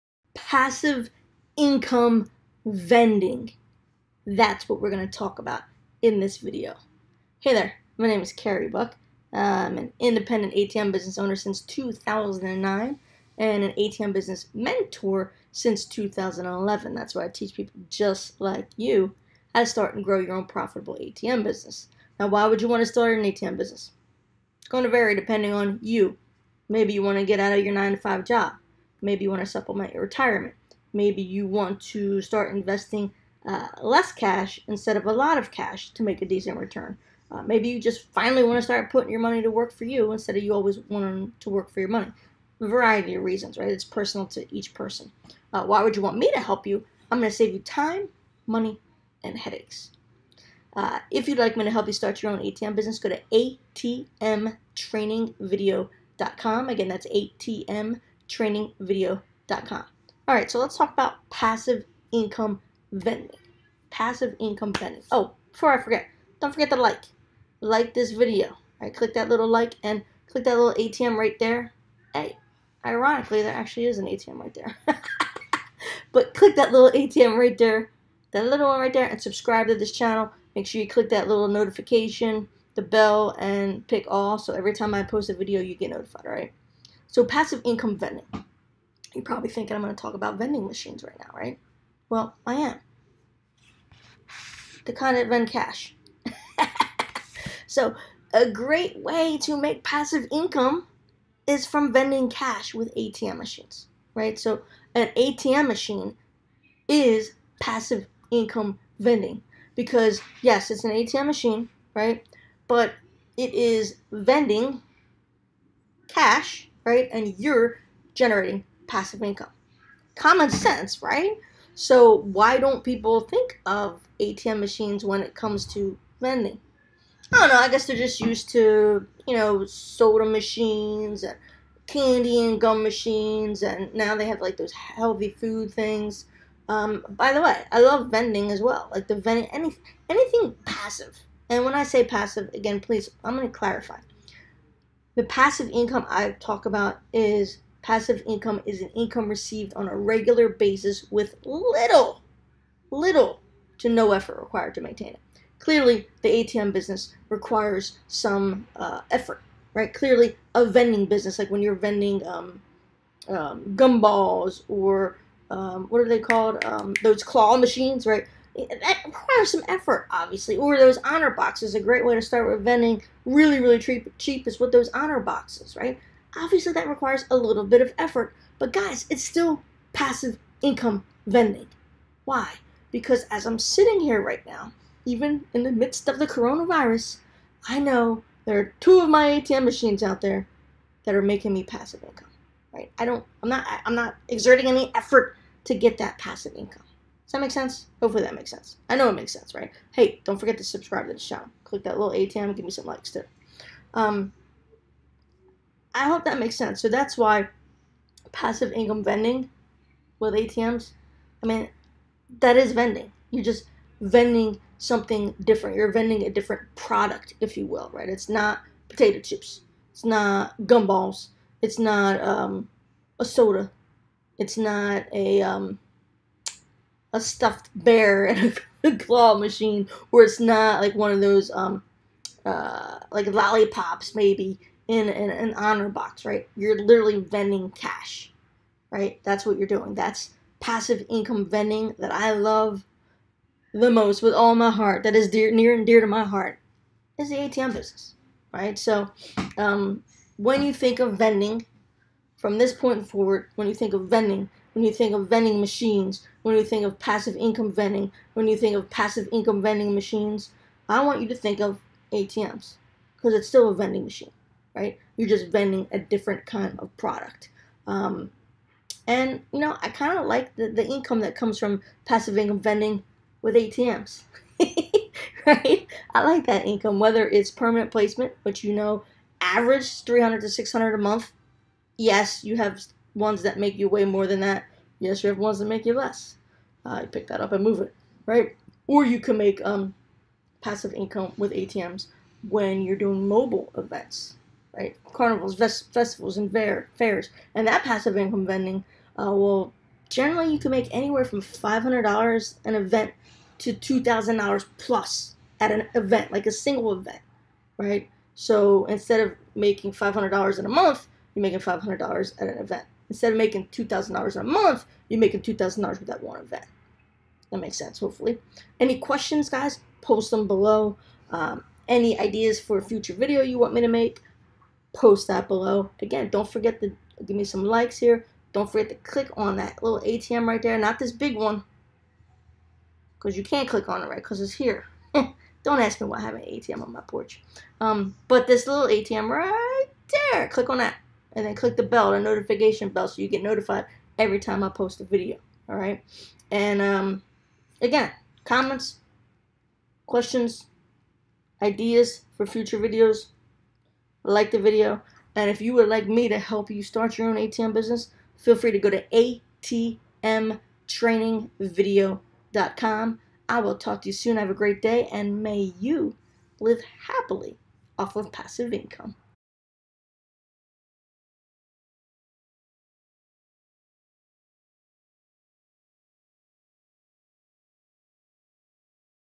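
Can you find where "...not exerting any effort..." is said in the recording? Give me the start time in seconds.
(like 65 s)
193 s.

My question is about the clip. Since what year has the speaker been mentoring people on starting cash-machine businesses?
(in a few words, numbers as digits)
2011.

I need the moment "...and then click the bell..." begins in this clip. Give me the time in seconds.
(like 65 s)
341 s.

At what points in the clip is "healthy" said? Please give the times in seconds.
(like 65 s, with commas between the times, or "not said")
134 s.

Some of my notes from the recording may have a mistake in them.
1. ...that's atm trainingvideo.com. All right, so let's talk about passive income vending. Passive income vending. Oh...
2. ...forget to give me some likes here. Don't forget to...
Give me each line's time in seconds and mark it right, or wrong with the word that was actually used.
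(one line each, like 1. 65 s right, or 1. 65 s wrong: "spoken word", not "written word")
1. 56 s right
2. 326 s right.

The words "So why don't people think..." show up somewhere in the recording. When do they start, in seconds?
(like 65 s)
121 s.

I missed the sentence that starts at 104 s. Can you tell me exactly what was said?
So an ATM machine is passive income vending because yes, it's an ATM machine, right?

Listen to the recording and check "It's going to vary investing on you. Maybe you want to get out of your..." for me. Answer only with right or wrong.
wrong.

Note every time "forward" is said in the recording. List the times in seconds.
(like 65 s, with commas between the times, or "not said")
253 s.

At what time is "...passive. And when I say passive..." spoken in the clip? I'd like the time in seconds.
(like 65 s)
140 s.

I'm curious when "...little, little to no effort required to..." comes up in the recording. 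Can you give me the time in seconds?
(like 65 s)
151 s.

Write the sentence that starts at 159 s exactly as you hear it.
Clearly, a vending business, like when you're vending um, um, gumballs or um, what are they called?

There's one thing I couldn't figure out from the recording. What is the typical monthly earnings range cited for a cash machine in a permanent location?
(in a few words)
300 to 600.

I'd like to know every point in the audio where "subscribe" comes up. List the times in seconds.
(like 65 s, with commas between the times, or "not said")
79 s, 200 s.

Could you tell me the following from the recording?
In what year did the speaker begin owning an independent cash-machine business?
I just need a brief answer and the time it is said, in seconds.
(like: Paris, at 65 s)
2009, at 11 s.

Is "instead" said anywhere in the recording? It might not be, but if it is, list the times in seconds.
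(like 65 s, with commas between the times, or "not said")
34 s, 40 s, 308 s, 313 s.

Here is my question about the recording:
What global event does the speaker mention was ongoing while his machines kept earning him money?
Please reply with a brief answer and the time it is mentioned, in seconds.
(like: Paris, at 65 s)
coronavirus, at 186 s.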